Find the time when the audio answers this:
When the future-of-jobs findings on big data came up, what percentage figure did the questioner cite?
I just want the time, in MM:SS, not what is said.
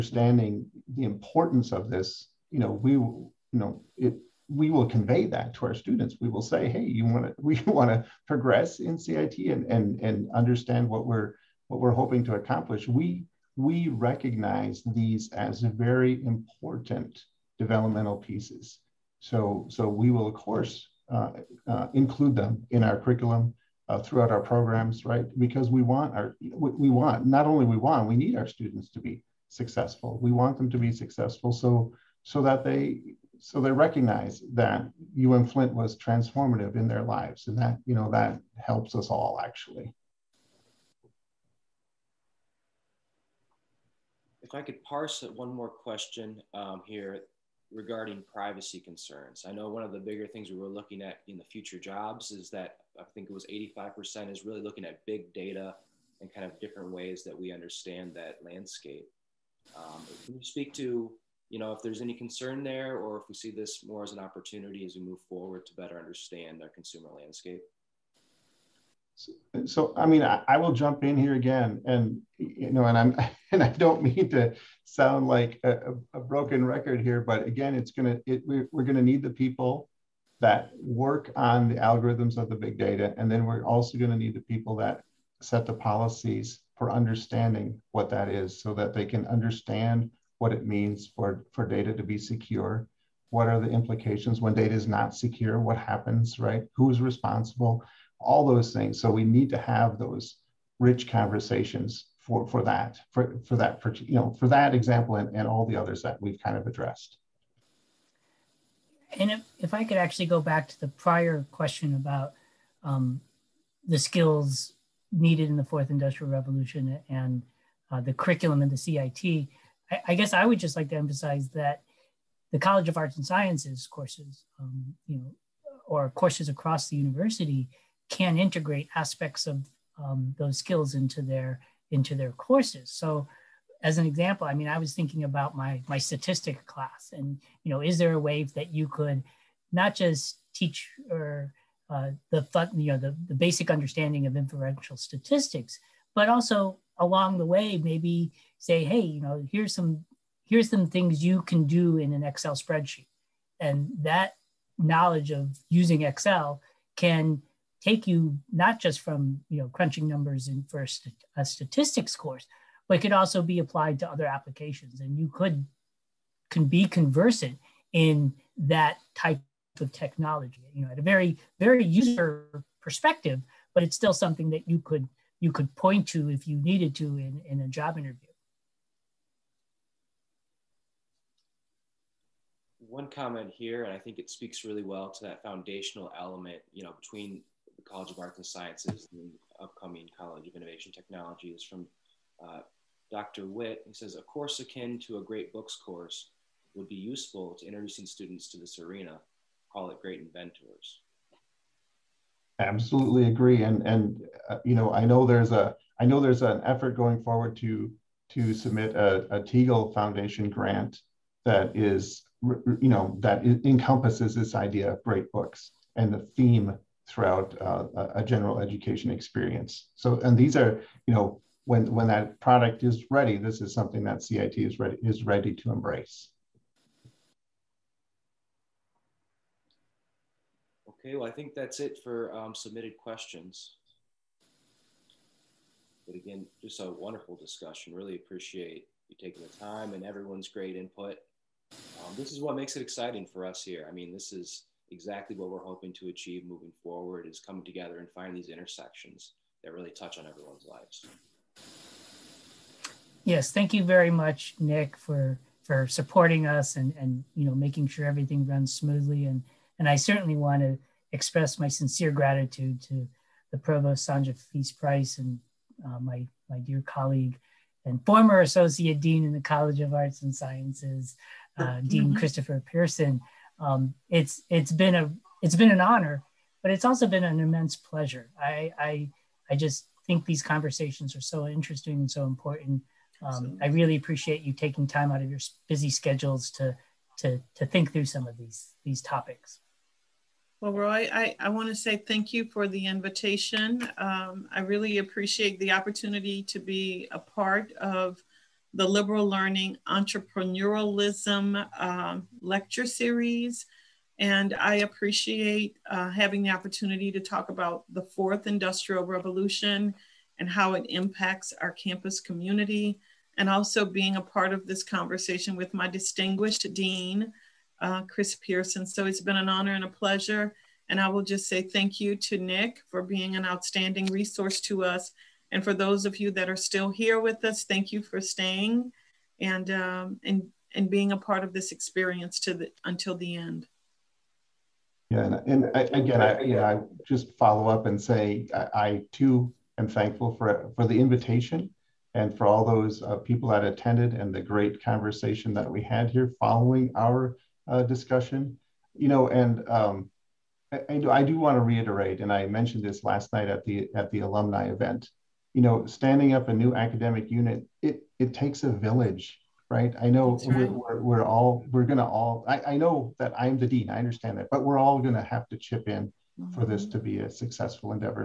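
00:53.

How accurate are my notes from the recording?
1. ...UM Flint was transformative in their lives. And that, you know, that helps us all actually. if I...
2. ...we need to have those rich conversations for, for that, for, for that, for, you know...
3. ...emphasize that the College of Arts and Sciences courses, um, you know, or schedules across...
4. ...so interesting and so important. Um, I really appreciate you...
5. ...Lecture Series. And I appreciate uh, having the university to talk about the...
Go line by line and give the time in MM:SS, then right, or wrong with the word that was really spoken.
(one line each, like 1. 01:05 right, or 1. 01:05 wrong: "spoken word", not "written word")
1. 00:35 right
2. 01:39 right
3. 02:00 wrong: "courses", not "schedules"
4. 04:41 right
5. 05:02 wrong: "opportunity", not "university".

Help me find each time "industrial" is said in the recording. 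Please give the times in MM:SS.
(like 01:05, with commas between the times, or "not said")
01:55, 05:08.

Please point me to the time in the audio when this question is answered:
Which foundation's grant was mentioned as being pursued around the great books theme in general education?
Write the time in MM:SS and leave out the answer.
03:29.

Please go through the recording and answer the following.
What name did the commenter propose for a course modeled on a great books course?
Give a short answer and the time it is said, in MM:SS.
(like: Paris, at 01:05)
Great inventors, at 03:20.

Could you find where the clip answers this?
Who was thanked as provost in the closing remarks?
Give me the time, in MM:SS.
04:24.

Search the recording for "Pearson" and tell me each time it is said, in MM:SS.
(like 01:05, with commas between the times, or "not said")
04:32, 05:18.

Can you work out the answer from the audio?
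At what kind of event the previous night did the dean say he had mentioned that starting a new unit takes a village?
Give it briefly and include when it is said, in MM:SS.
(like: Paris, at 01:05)
Alumni event, at 05:54.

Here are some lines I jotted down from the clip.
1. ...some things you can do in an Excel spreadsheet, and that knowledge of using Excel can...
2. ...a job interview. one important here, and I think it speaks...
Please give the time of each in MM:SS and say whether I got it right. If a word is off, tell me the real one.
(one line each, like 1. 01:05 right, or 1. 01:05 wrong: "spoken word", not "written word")
1. 02:30 right
2. 02:57 wrong: "comment", not "important".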